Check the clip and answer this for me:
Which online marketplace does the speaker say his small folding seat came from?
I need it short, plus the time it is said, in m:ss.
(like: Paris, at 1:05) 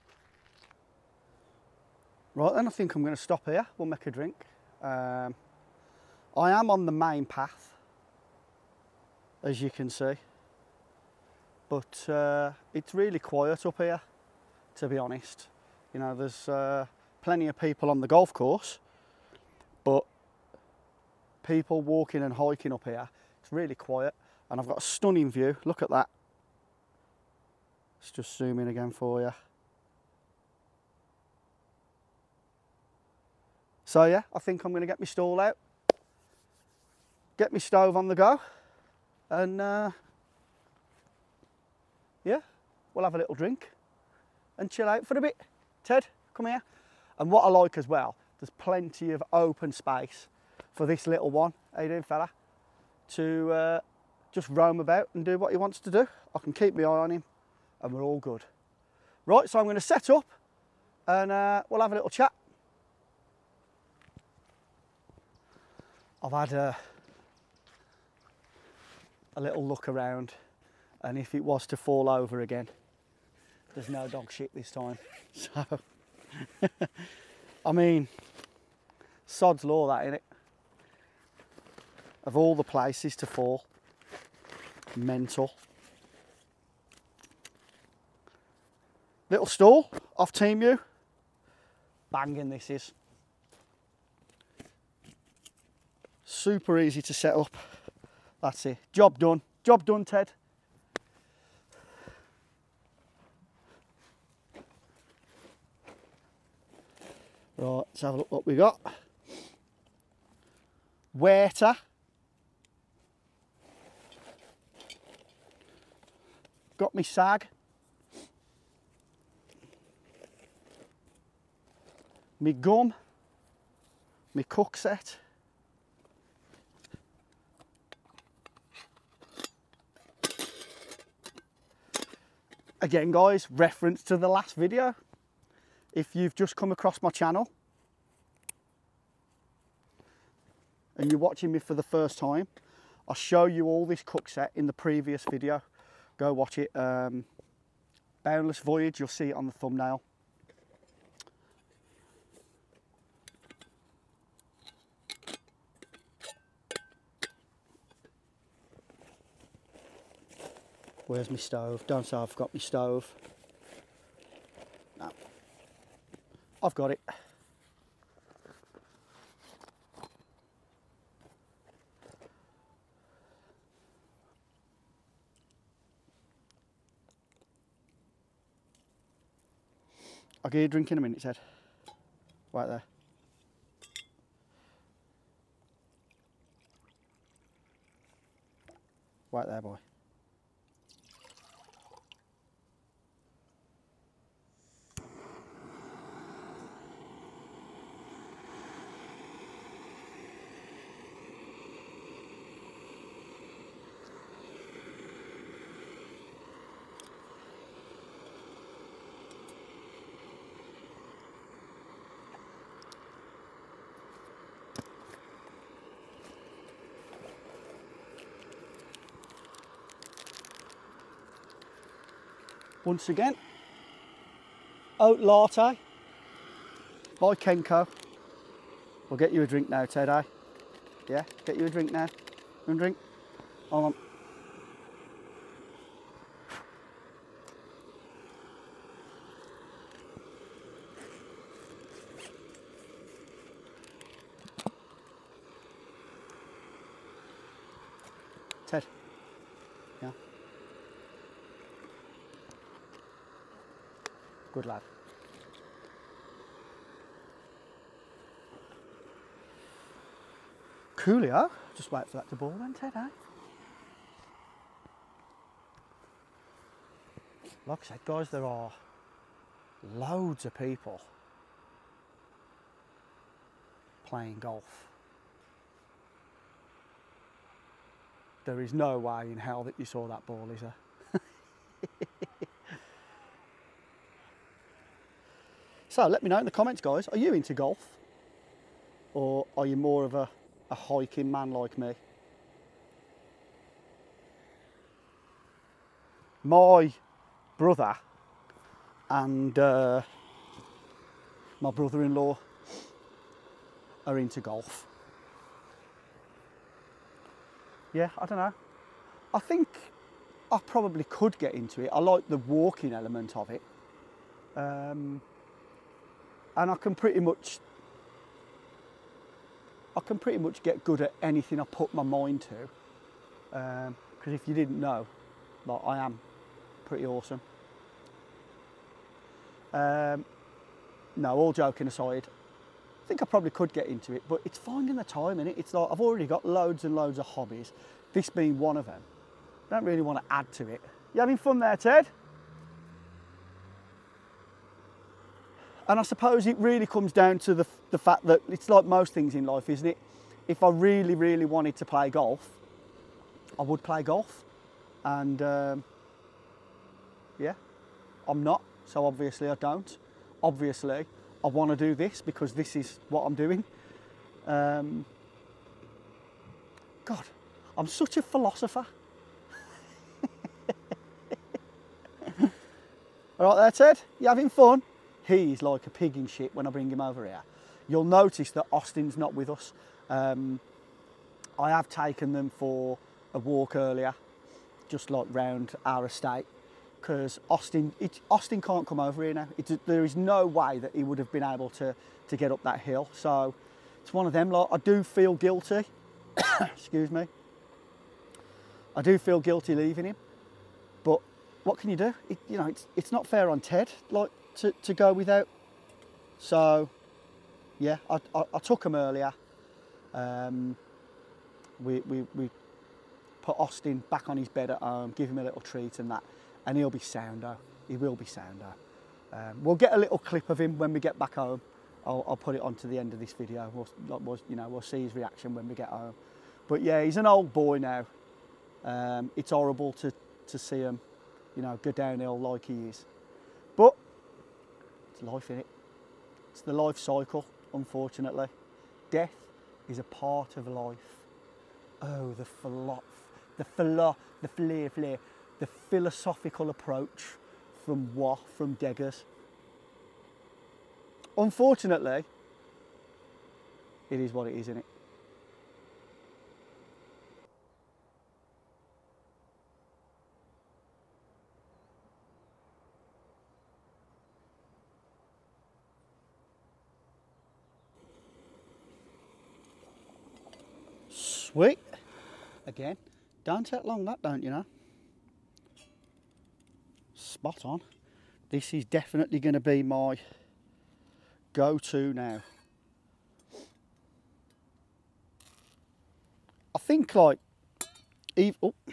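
Temu, at 1:30.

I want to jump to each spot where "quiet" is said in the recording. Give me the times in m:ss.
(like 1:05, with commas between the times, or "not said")
0:13, 0:23.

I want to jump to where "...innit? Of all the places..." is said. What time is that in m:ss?
1:20.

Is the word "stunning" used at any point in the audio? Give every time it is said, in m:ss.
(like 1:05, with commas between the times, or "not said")
0:24.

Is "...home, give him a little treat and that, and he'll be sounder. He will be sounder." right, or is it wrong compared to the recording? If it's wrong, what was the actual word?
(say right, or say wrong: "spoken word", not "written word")
right.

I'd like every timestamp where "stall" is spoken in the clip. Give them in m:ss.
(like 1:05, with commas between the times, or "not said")
0:35, 1:29.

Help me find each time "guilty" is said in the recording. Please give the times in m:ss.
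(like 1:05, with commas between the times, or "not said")
6:35, 6:39.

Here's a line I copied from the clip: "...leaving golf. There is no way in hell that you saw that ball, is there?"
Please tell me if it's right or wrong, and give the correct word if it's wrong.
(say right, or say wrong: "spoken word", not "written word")
wrong: "playing", not "leaving".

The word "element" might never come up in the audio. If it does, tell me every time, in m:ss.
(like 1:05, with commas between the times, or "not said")
5:12.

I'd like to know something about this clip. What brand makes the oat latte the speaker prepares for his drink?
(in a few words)
Kenco.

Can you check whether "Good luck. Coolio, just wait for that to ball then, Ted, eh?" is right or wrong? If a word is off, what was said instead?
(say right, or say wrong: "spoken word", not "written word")
right.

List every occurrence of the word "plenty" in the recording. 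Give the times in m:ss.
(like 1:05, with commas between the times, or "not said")
0:17, 0:48.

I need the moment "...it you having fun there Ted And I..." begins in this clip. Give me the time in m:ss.
5:40.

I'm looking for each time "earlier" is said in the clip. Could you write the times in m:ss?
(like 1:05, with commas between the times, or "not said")
6:23, 6:48.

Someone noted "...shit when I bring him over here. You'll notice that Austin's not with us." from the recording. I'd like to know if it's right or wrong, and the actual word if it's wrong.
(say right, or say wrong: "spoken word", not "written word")
right.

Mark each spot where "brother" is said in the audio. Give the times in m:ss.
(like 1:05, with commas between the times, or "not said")
4:57, 5:01.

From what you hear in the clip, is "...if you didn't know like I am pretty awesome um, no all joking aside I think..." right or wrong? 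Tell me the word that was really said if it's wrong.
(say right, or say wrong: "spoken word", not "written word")
right.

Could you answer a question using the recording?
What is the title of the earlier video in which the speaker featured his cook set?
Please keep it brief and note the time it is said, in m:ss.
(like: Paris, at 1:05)
Boundless Voyage, at 2:28.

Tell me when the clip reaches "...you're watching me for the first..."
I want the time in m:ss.
2:21.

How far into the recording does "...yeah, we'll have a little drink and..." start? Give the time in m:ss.
0:42.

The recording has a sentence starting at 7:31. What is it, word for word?
Unfortunately, it is what it is, isn't it?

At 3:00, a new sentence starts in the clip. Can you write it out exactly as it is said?
I'll get you a drink in a minute, Ted.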